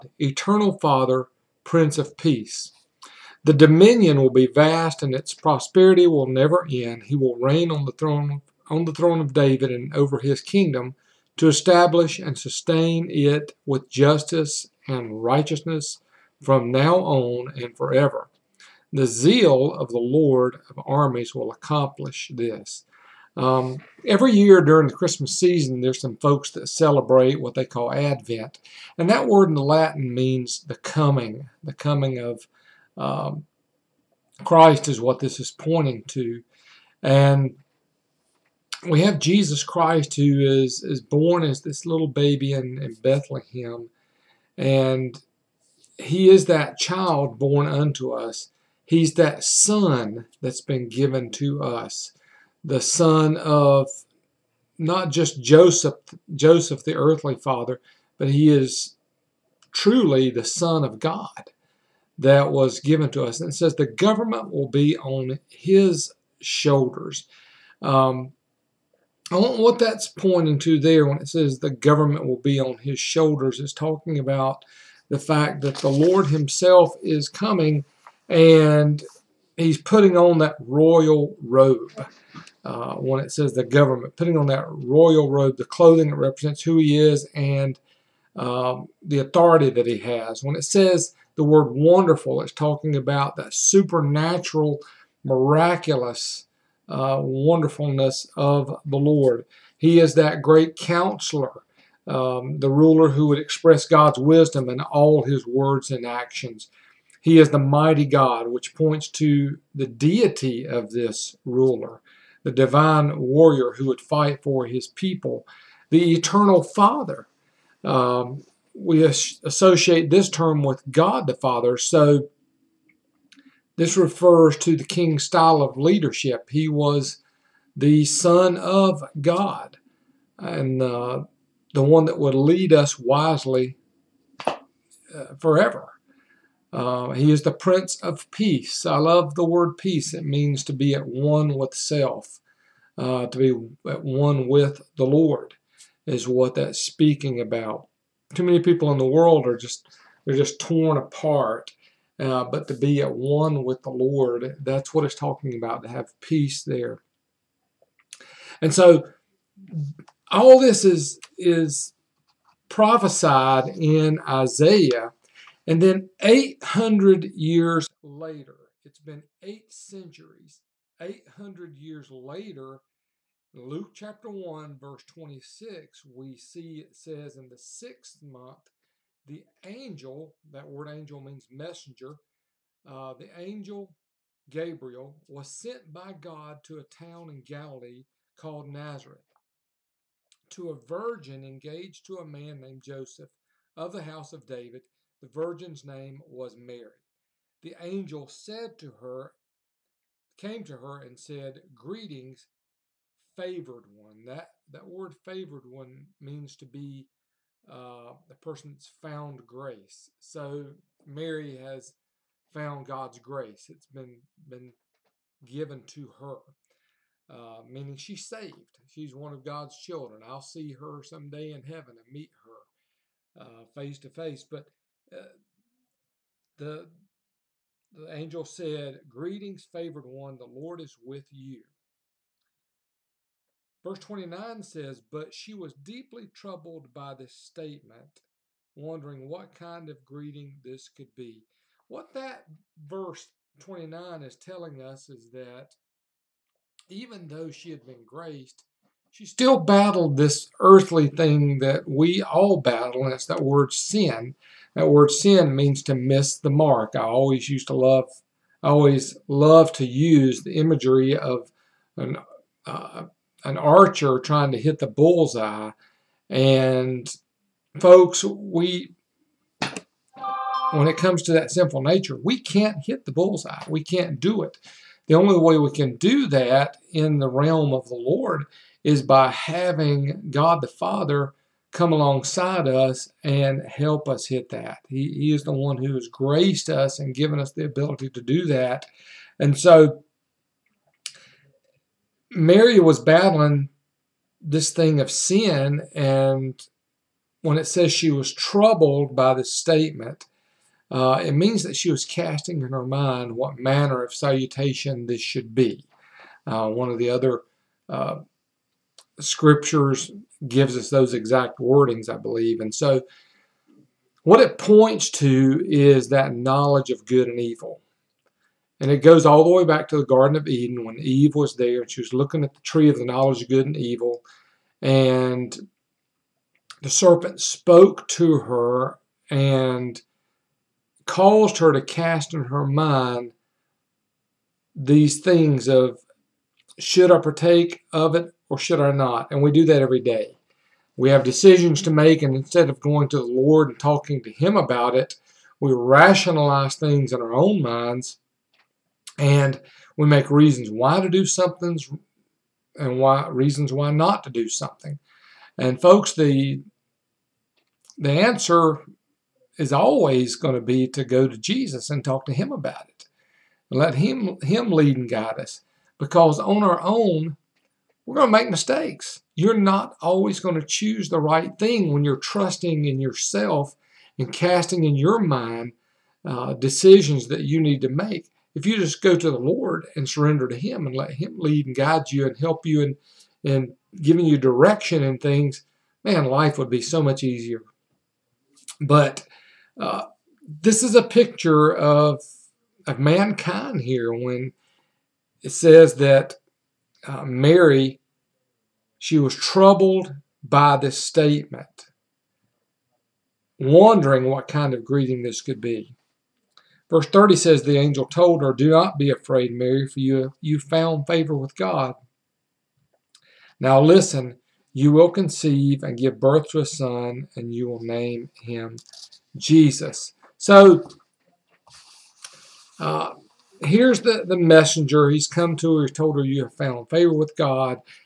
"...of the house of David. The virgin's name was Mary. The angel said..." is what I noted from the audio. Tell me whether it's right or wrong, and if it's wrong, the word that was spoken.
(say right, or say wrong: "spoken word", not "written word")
right.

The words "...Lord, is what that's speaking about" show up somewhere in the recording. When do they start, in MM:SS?
02:25.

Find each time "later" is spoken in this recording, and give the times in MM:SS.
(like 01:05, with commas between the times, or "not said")
02:48, 02:52.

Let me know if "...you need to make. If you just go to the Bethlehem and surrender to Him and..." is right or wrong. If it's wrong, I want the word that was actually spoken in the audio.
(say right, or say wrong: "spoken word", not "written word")
wrong: "Lord", not "Bethlehem".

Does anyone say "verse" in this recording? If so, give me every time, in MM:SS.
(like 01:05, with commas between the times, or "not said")
02:54, 03:53, 04:02, 06:46.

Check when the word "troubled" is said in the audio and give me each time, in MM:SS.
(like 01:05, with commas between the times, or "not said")
03:56, 04:58, 06:39.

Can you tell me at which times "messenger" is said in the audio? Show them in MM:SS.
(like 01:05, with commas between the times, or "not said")
03:01, 07:04.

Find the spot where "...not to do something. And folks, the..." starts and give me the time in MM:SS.
05:53.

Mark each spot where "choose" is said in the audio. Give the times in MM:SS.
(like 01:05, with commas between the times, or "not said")
06:10.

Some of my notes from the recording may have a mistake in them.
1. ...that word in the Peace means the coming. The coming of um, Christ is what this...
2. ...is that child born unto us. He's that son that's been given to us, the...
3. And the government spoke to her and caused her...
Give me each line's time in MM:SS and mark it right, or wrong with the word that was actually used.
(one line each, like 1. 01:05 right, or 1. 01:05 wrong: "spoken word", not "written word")
1. 00:29 wrong: "Latin", not "Peace"
2. 00:46 right
3. 05:24 wrong: "serpent", not "government".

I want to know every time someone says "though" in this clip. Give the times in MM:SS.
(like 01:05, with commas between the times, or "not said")
04:07.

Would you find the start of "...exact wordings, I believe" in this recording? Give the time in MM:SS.
05:11.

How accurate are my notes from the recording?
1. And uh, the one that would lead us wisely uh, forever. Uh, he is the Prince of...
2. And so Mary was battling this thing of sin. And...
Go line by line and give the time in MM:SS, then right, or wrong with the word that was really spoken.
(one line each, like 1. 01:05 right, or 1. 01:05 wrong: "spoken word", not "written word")
1. 02:10 right
2. 04:49 right.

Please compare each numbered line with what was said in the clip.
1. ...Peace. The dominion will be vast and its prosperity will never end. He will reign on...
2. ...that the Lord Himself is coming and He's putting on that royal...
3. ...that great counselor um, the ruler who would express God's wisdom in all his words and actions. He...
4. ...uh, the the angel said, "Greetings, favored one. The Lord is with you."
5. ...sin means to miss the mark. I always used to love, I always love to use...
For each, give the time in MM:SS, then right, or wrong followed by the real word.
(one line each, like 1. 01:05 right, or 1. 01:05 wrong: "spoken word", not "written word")
1. 00:02 right
2. 01:15 right
3. 01:40 right
4. 03:45 right
5. 04:15 right.